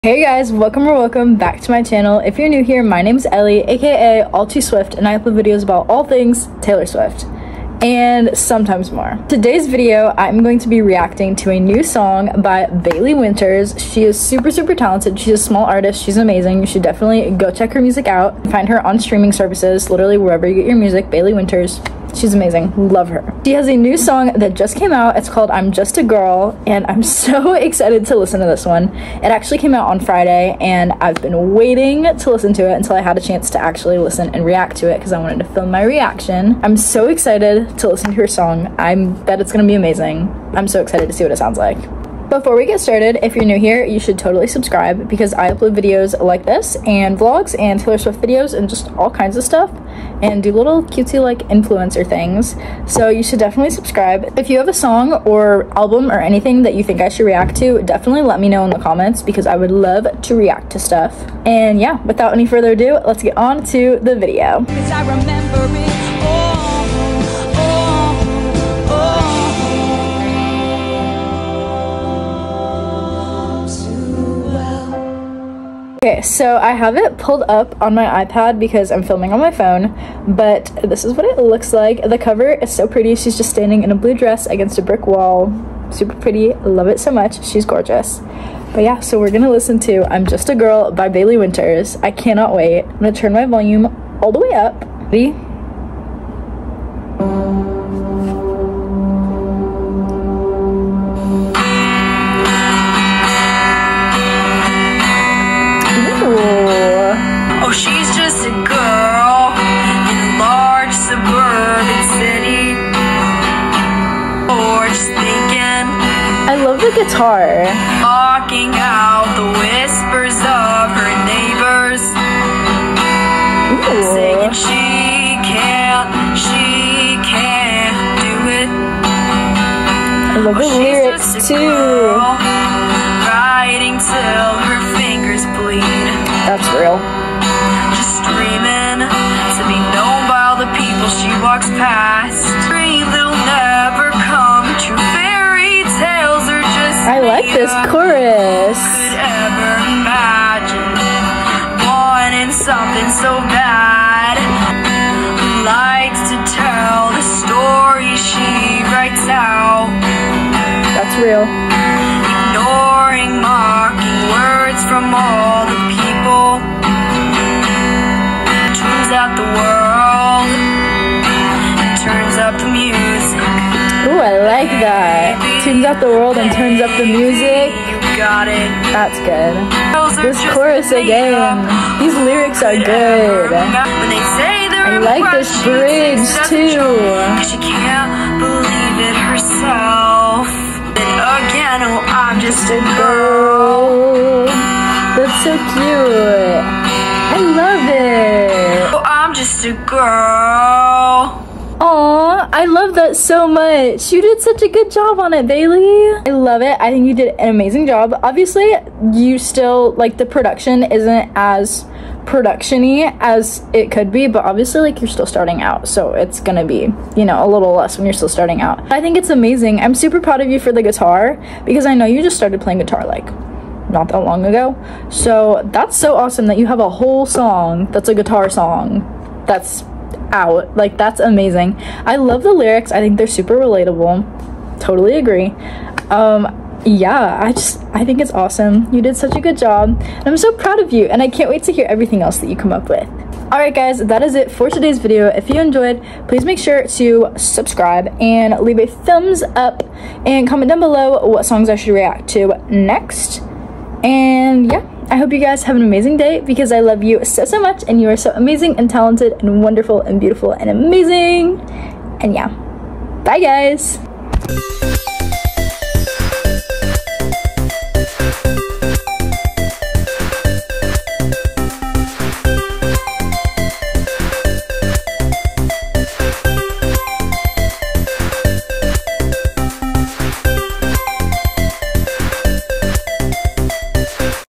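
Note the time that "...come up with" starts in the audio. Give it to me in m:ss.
4:02.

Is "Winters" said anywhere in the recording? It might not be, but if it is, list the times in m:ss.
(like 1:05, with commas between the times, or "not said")
0:13, 0:21, 1:31.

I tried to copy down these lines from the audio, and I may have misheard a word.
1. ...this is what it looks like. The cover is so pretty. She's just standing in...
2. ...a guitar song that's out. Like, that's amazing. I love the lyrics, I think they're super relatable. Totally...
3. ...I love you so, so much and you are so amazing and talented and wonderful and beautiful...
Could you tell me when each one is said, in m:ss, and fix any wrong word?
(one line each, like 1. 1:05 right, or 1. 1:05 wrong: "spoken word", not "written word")
1. 1:20 right
2. 3:48 right
3. 4:16 right.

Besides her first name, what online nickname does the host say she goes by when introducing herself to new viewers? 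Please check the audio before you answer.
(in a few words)
All Too Swift.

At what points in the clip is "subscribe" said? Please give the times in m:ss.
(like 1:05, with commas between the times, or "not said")
0:44, 0:53, 4:07.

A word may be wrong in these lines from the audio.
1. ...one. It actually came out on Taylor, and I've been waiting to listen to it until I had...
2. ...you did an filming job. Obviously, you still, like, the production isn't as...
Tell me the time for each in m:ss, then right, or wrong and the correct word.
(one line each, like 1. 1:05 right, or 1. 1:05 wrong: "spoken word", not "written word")
1. 0:28 wrong: "Friday", not "Taylor"
2. 3:27 wrong: "amazing", not "filming".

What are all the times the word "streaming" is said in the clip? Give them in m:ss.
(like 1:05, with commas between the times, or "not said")
0:18.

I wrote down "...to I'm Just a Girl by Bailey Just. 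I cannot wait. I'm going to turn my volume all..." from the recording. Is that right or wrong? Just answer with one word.
wrong.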